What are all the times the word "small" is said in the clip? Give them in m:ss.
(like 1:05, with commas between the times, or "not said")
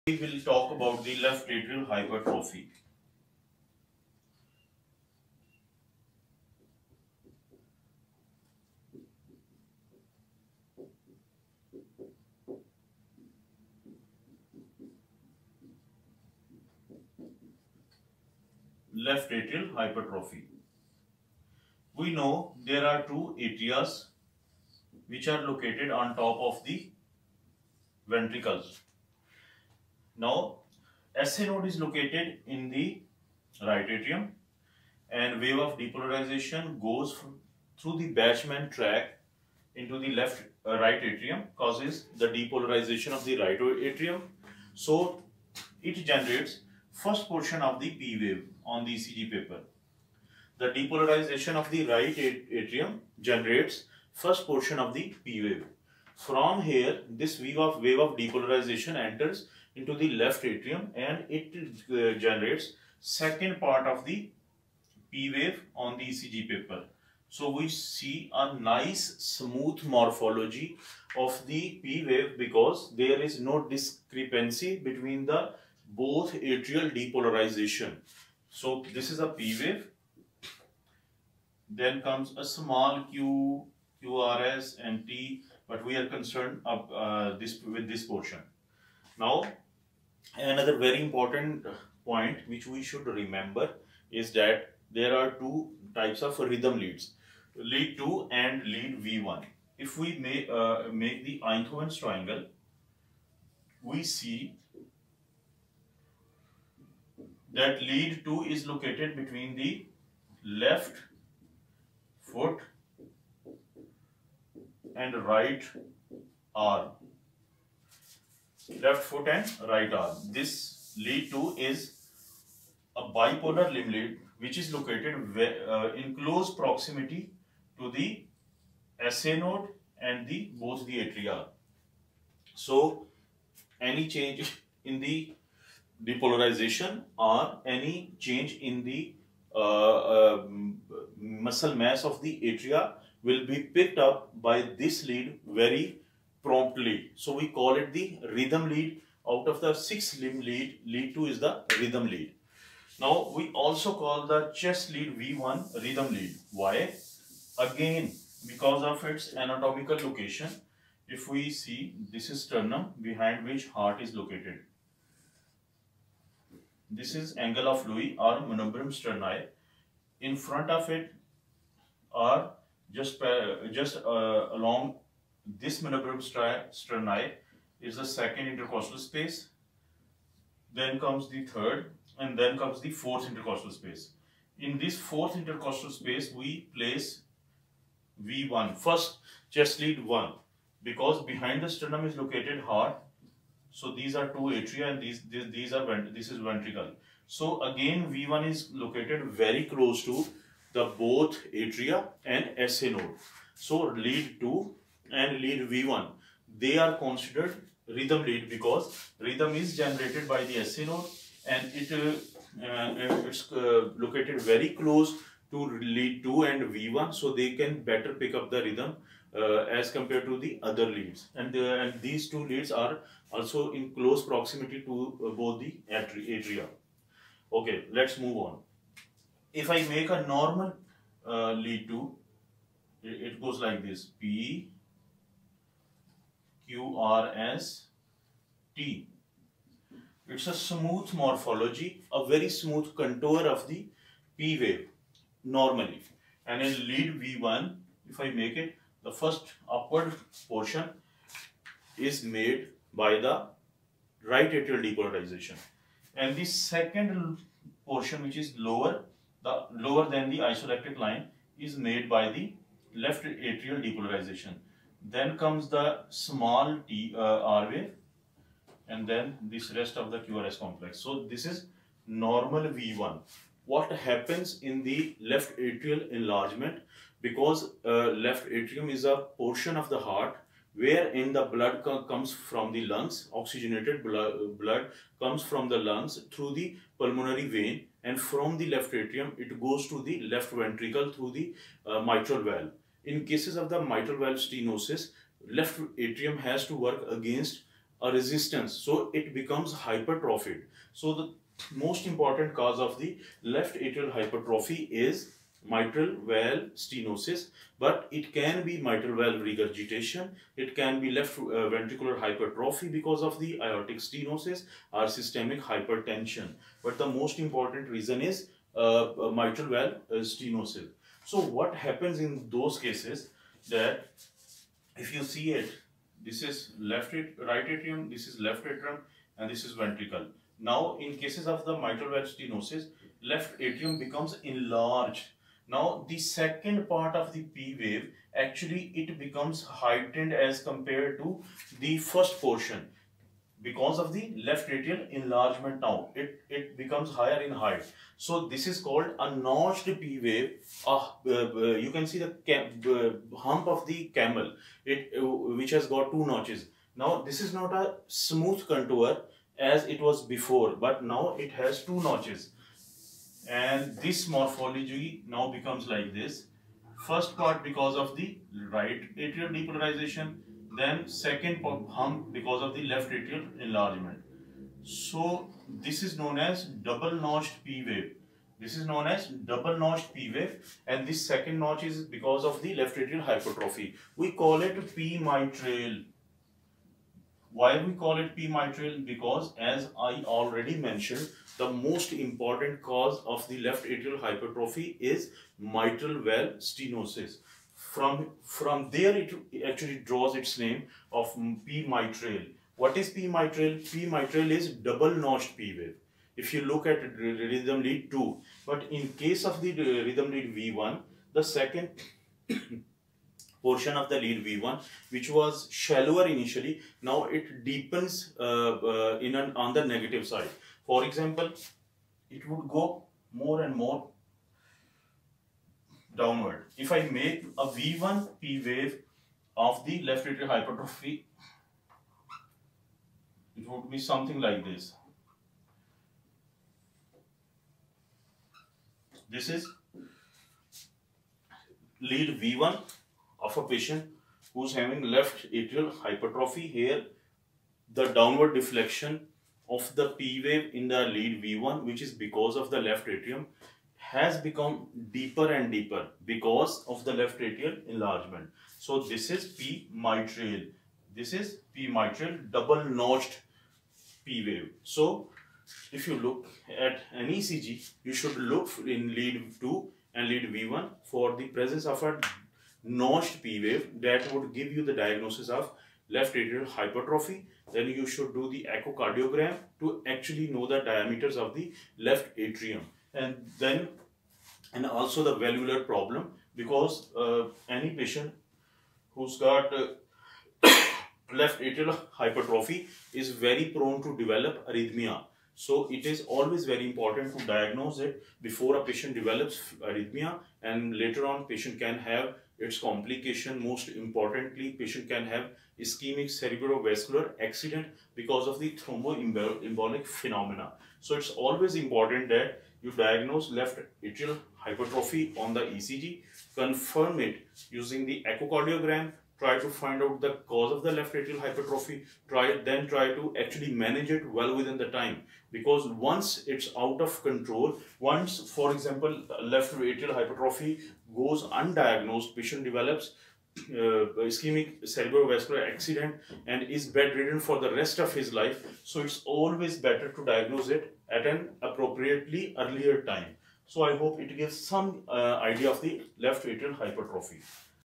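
1:22, 4:26.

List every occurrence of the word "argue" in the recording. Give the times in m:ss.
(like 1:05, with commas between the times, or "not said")
not said.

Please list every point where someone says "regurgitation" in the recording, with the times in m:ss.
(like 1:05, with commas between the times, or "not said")
5:09.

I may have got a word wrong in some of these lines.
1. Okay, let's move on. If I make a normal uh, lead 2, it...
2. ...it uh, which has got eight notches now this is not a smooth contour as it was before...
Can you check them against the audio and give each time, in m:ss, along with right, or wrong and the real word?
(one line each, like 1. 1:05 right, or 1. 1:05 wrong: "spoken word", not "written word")
1. 3:47 right
2. 5:54 wrong: "two", not "eight".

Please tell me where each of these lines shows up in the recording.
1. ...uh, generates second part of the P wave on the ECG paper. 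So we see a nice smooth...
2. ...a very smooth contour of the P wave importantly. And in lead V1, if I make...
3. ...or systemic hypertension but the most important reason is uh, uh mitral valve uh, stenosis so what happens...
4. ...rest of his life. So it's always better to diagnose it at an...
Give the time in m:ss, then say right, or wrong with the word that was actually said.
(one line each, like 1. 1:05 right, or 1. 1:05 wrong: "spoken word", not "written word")
1. 1:01 right
2. 4:02 wrong: "normally", not "importantly"
3. 5:14 right
4. 8:57 right.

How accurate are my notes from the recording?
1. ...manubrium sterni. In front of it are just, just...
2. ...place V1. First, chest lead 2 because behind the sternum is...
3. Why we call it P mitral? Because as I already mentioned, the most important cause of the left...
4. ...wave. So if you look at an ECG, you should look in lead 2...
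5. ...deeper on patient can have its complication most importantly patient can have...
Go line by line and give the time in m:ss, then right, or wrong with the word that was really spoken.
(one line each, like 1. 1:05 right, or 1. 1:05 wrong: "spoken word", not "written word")
1. 2:48 right
2. 3:06 wrong: "1", not "2"
3. 6:27 right
4. 7:44 right
5. 8:20 wrong: "later", not "deeper".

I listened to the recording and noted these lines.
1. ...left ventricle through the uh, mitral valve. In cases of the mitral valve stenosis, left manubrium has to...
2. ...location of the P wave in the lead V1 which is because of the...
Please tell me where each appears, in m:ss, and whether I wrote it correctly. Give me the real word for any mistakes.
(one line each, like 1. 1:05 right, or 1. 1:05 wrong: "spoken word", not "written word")
1. 4:50 wrong: "atrium", not "manubrium"
2. 7:28 wrong: "deflection", not "location".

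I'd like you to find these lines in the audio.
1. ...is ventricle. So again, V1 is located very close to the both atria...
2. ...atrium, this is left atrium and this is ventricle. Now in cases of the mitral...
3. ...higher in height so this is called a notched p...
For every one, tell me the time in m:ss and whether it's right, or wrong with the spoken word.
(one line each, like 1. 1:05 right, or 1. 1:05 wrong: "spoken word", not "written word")
1. 3:16 right
2. 5:27 right
3. 5:47 right.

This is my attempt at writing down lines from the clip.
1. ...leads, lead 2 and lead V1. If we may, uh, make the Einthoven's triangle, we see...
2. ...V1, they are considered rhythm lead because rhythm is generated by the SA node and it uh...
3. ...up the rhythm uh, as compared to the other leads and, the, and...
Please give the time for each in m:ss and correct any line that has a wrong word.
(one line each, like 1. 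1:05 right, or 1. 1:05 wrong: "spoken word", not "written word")
1. 1:36 right
2. 3:25 right
3. 3:38 right.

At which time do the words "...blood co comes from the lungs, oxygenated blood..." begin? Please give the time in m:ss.
4:41.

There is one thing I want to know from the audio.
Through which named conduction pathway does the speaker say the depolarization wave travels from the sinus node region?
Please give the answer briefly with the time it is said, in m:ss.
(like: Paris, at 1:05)
Bachmann tract, at 0:38.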